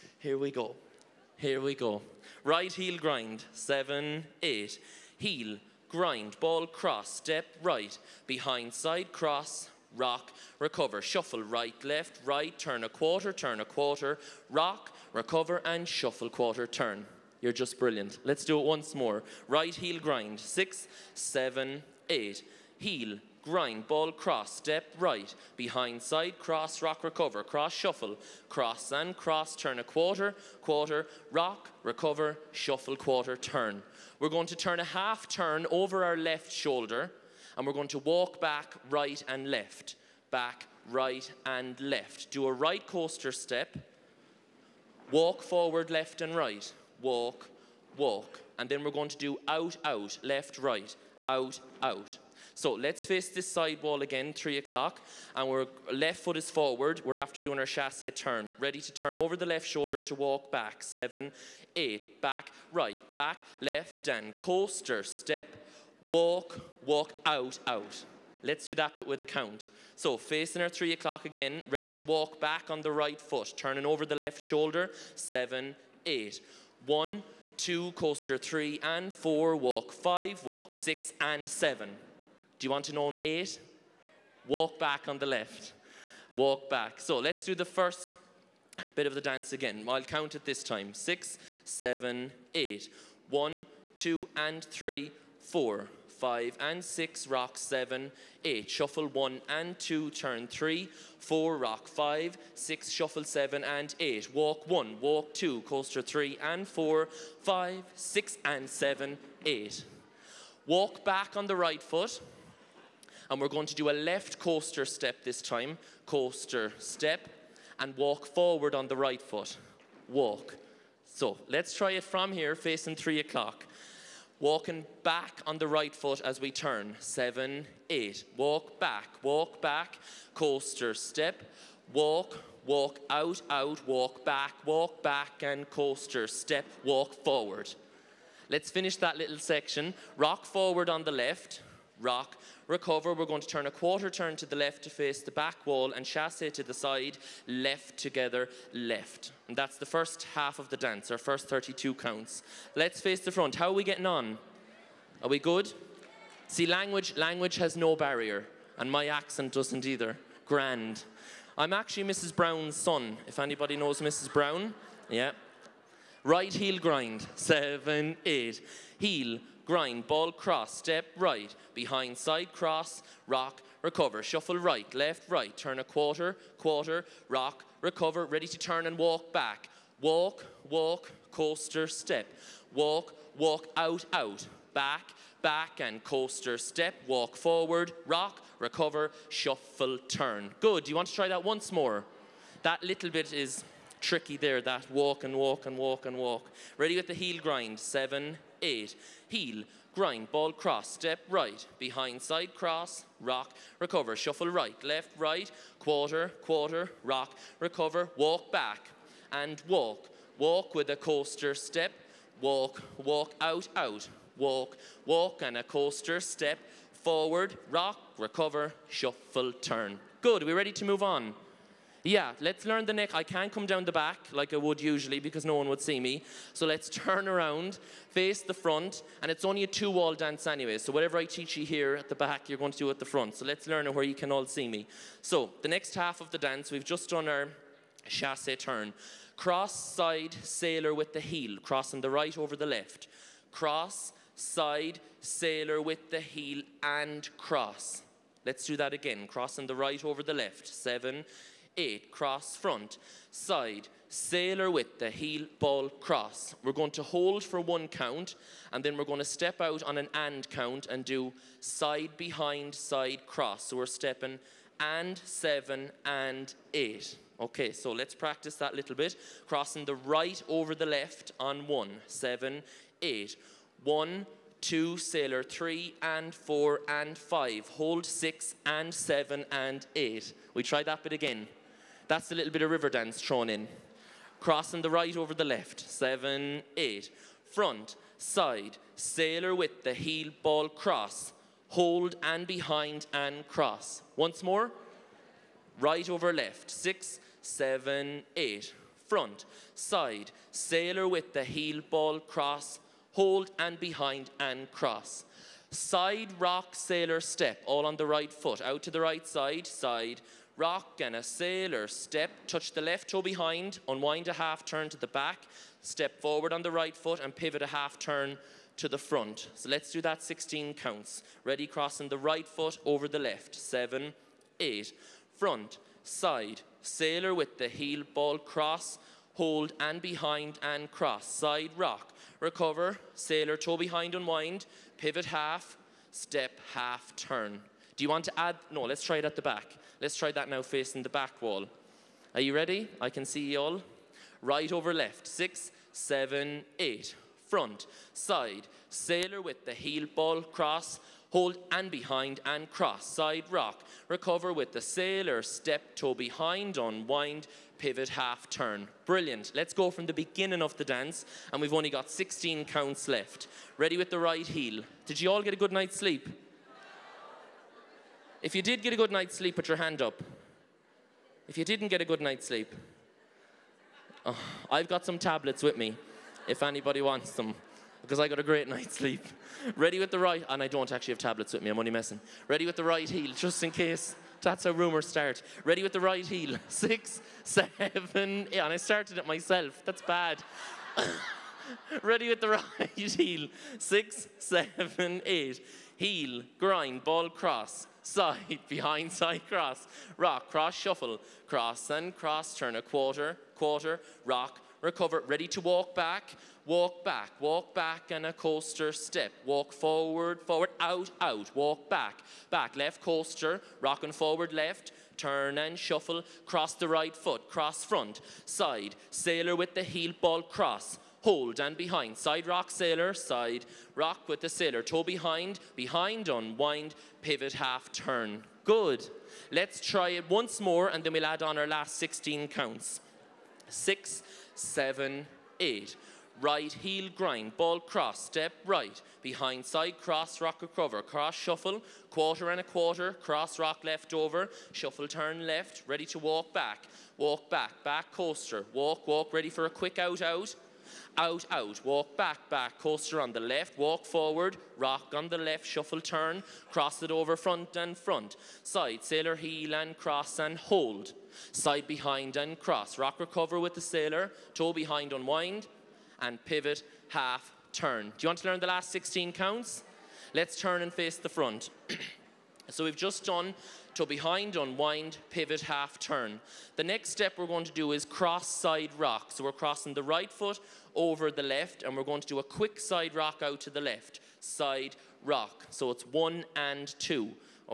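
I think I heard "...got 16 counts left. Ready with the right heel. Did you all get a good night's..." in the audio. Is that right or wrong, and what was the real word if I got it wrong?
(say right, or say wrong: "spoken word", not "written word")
right.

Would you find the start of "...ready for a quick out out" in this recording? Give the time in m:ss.
7:29.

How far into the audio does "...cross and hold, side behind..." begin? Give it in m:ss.
7:39.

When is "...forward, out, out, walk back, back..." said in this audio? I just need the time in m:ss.
6:50.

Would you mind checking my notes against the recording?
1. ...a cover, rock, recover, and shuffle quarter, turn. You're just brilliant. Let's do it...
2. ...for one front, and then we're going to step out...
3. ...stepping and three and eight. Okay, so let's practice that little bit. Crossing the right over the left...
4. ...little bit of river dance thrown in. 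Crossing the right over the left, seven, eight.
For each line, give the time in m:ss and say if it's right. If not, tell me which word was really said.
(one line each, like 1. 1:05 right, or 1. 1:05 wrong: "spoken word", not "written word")
1. 0:13 wrong: "quarter", not "cover"
2. 4:17 wrong: "count", not "front"
3. 4:23 wrong: "seven", not "three"
4. 4:42 right.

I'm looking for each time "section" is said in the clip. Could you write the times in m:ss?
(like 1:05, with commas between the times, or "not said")
2:19.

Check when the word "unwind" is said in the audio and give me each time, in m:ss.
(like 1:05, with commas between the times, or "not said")
5:13, 5:34, 5:56, 7:06, 7:45, 7:54.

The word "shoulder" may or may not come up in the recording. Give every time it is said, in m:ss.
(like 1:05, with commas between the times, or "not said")
0:36, 0:59, 1:14.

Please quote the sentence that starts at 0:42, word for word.
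Do a right coaster step, walk forward, left and right, walk, walk.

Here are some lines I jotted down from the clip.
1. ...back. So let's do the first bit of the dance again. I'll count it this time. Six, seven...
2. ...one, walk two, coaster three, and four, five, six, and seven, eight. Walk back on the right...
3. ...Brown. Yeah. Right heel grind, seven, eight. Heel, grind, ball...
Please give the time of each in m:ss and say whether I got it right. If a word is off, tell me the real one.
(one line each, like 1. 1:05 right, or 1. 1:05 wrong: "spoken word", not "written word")
1. 1:26 right
2. 1:44 right
3. 2:44 right.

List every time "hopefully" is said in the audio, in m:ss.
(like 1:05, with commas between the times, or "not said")
not said.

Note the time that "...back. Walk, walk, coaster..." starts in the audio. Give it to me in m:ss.
2:59.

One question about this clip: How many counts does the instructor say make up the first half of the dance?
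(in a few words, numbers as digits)
32.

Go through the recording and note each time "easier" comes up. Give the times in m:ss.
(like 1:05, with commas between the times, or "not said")
not said.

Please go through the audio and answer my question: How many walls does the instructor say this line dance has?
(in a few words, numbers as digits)
2.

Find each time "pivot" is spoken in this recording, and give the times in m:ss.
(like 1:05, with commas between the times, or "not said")
5:17, 5:34, 5:57, 7:07, 7:46, 7:55.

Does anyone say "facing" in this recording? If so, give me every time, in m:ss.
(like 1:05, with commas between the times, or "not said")
1:10, 2:02, 5:40.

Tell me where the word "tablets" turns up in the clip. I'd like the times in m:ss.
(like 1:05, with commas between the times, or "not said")
6:15, 6:21.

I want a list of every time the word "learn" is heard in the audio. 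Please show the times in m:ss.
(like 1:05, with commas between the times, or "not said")
3:42, 3:53, 7:48.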